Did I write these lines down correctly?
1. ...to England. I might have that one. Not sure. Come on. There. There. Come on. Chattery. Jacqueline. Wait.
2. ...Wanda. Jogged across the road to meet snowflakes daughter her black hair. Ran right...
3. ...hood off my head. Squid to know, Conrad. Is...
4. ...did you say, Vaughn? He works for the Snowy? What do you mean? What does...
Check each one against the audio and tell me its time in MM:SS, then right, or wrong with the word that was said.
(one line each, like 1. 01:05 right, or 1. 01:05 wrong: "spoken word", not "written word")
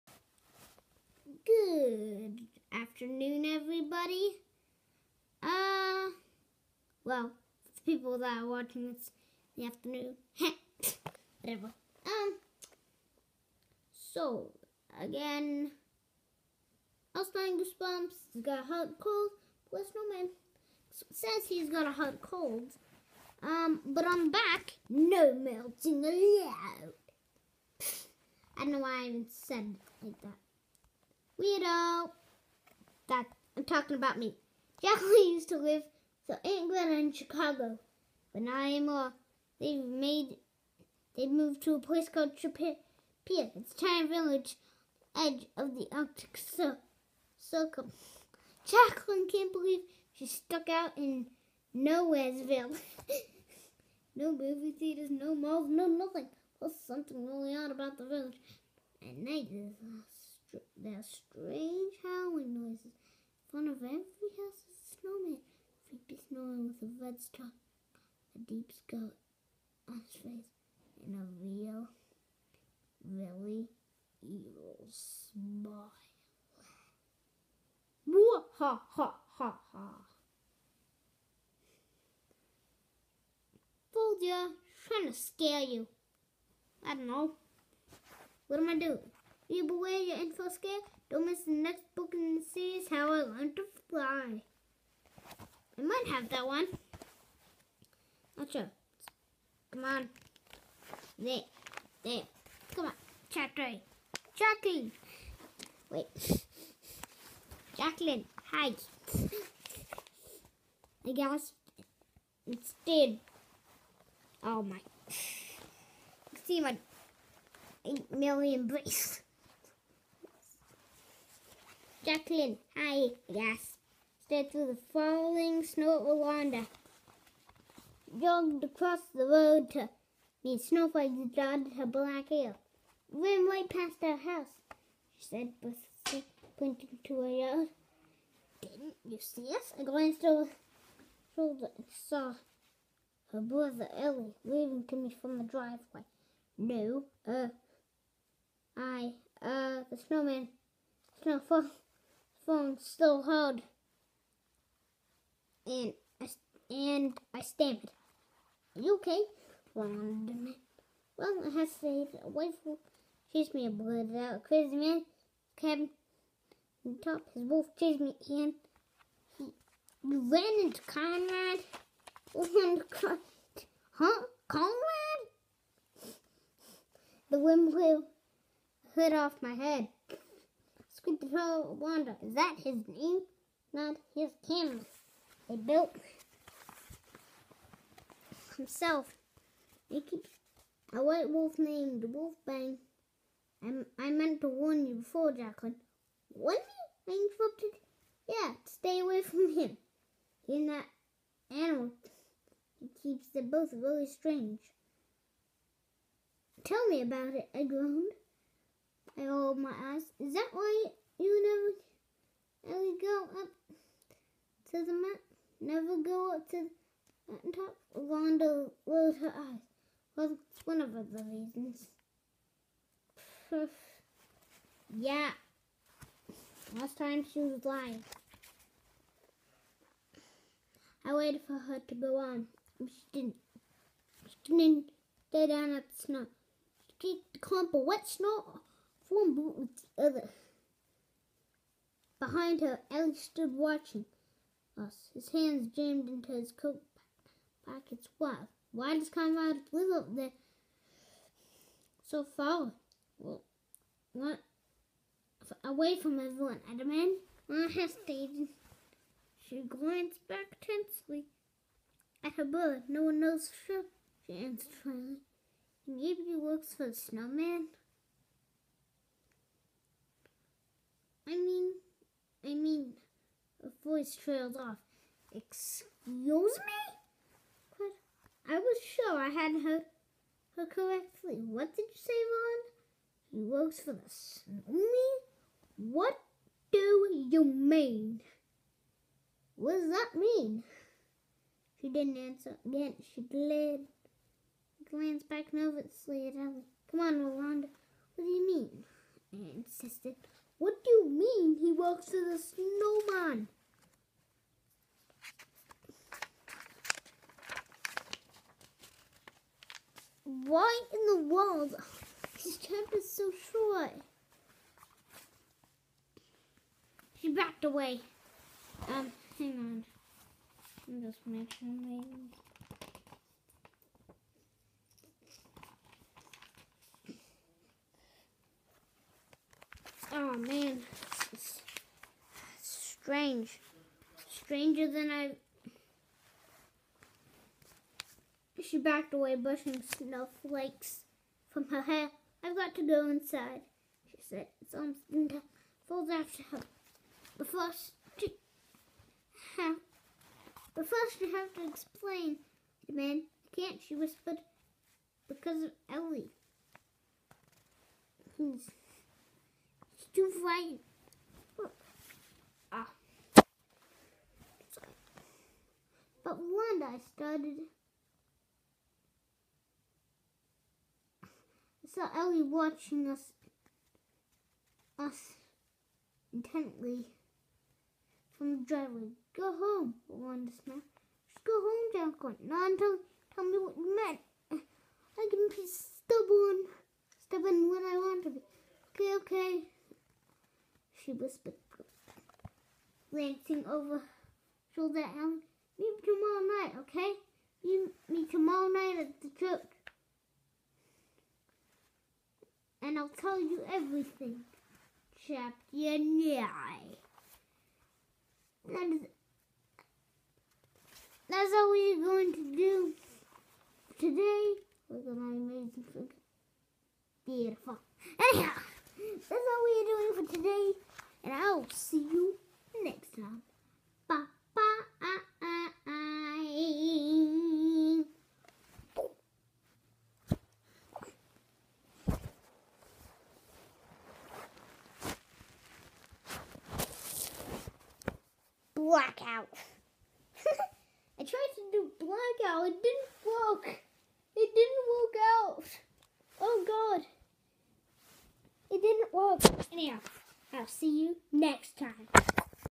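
1. 01:33 wrong: "Fly", not "England"
2. 02:06 right
3. 02:58 wrong: "Wanda", not "Conrad"
4. 04:41 right.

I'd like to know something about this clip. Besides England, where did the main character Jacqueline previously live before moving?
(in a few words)
Chicago.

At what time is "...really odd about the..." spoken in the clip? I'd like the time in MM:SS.
00:57.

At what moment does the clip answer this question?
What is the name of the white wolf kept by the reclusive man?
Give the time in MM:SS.
03:12.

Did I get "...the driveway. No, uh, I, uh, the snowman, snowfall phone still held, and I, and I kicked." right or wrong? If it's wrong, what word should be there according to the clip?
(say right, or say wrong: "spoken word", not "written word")
wrong: "stammered", not "kicked".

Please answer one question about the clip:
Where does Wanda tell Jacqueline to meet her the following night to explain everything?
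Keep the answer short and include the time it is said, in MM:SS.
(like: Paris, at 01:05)
The church, at 06:39.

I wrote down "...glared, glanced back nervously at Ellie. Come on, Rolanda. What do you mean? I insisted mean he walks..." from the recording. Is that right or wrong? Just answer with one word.
right.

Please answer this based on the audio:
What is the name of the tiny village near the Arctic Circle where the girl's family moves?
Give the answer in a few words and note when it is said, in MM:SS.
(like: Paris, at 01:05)
Chapia, at 00:42.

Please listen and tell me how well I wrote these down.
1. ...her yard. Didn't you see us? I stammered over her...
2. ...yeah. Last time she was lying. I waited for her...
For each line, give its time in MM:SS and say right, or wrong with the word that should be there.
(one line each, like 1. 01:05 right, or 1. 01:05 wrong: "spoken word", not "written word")
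1. 02:17 wrong: "glanced", not "stammered"
2. 03:44 right.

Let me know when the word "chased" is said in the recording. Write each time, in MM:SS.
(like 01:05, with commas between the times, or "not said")
02:43, 02:47.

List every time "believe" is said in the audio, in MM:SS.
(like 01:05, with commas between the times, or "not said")
00:49.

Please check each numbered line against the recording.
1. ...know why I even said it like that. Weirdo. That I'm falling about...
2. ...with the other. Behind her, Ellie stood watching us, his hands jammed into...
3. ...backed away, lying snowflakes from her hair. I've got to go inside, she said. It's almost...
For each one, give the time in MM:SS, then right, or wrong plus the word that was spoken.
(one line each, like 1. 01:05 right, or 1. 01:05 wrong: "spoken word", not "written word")
1. 00:28 wrong: "talking", not "falling"
2. 03:59 right
3. 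05:38 wrong: "brushing", not "lying".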